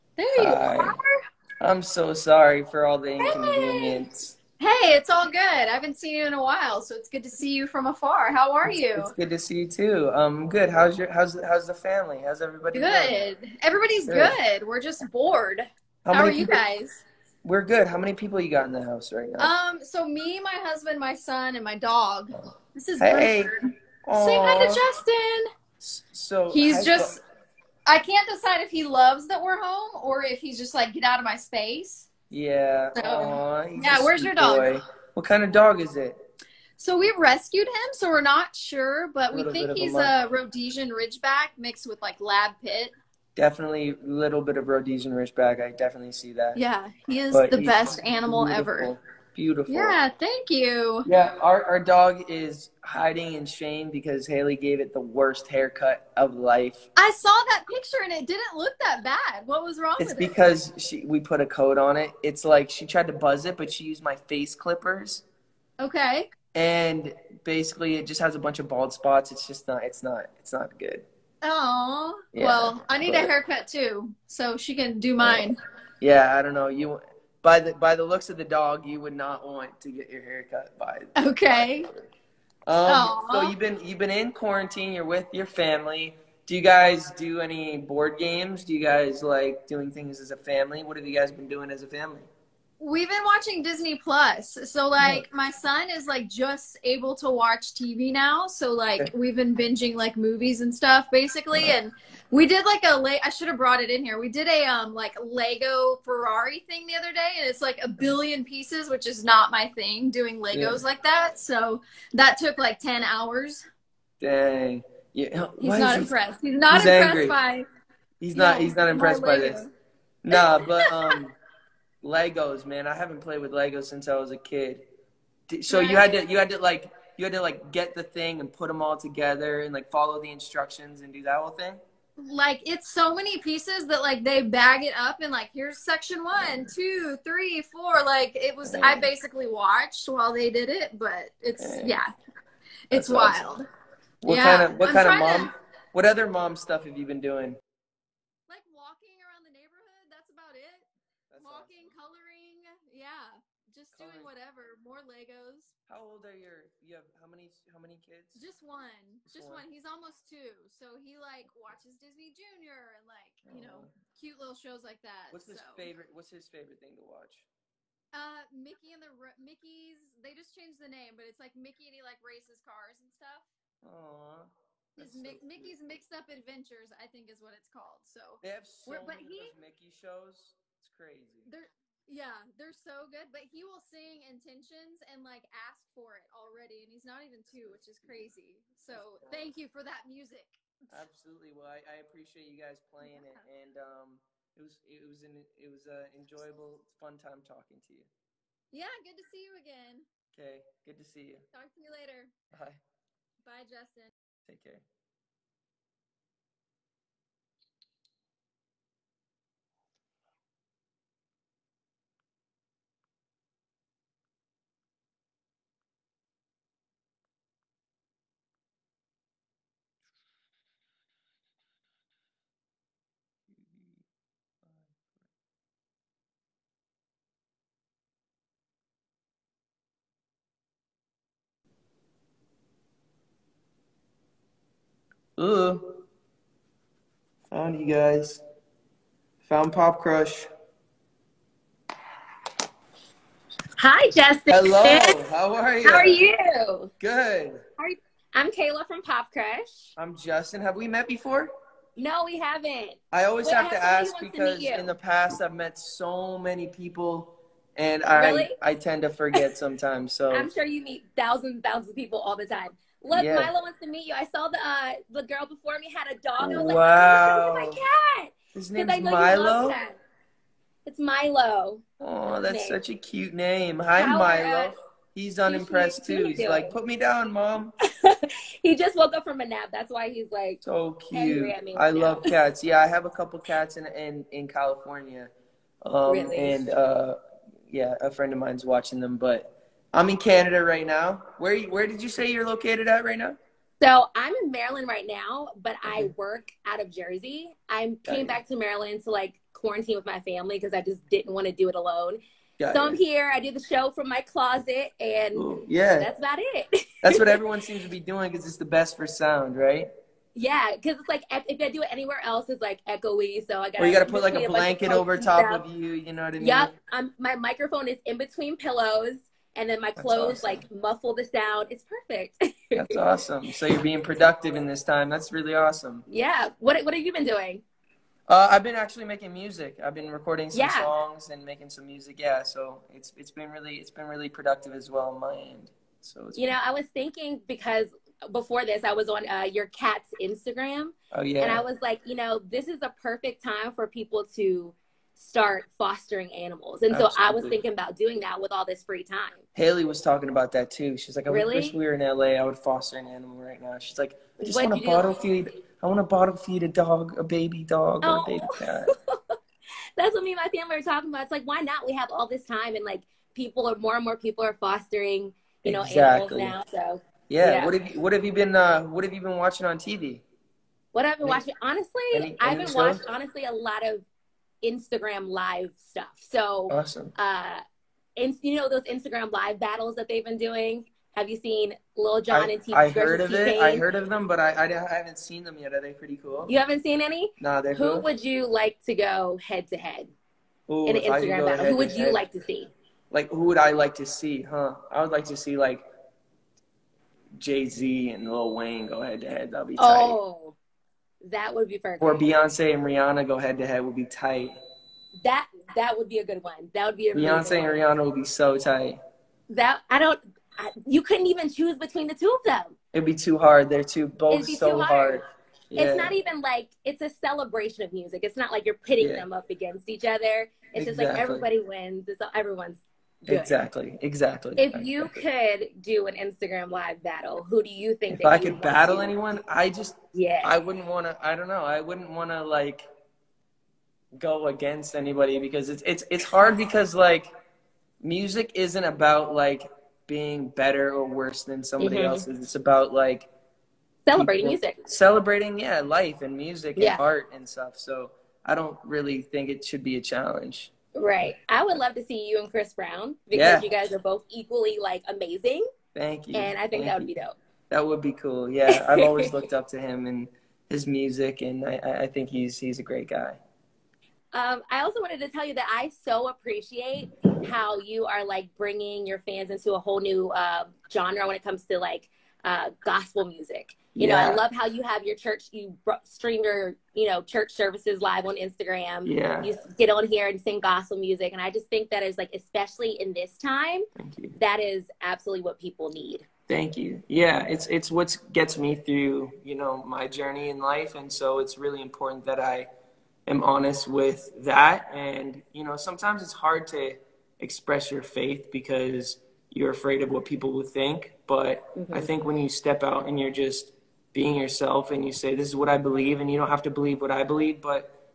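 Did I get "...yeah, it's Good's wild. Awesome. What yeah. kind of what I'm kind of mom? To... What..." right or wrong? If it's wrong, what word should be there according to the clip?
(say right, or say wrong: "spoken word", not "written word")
wrong: "That", not "Good".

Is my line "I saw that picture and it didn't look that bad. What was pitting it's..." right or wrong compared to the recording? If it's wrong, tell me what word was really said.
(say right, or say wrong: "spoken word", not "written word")
wrong: "wrong", not "pitting".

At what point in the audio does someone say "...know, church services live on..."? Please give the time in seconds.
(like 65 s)
477 s.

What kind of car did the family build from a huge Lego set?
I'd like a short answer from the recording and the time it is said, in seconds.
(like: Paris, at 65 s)
Ferrari, at 106 s.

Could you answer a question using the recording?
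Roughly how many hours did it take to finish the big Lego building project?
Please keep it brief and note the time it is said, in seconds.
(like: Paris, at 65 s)
10, at 112 s.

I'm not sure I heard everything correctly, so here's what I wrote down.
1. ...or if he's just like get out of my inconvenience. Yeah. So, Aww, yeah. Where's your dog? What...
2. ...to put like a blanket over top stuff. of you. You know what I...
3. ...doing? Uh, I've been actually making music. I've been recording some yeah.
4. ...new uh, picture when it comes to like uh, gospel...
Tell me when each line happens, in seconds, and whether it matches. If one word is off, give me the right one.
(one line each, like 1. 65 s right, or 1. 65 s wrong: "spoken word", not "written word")
1. 30 s wrong: "space", not "inconvenience"
2. 314 s right
3. 327 s right
4. 469 s wrong: "genre", not "picture".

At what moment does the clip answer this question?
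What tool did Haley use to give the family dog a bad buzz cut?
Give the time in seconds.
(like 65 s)
64 s.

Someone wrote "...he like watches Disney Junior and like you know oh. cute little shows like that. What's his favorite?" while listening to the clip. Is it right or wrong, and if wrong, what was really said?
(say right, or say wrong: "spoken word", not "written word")
right.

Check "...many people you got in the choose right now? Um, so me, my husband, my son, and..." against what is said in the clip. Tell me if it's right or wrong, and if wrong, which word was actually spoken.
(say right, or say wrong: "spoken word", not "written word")
wrong: "house", not "choose".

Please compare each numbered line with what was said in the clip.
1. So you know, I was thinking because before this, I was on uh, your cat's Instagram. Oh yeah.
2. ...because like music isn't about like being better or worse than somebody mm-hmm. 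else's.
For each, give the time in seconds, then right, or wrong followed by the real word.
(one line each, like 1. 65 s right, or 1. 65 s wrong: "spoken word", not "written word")
1. 336 s right
2. 436 s right.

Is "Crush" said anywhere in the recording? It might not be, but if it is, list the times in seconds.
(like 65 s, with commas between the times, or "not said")
239 s, 249 s.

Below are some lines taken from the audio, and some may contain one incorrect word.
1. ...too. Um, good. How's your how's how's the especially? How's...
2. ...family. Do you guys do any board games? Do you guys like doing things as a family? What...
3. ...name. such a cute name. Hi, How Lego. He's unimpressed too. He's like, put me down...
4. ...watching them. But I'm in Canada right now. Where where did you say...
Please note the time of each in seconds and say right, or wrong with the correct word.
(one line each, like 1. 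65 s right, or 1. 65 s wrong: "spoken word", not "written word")
1. 9 s wrong: "family", not "especially"
2. 85 s right
3. 272 s wrong: "Milo", not "Lego"
4. 288 s right.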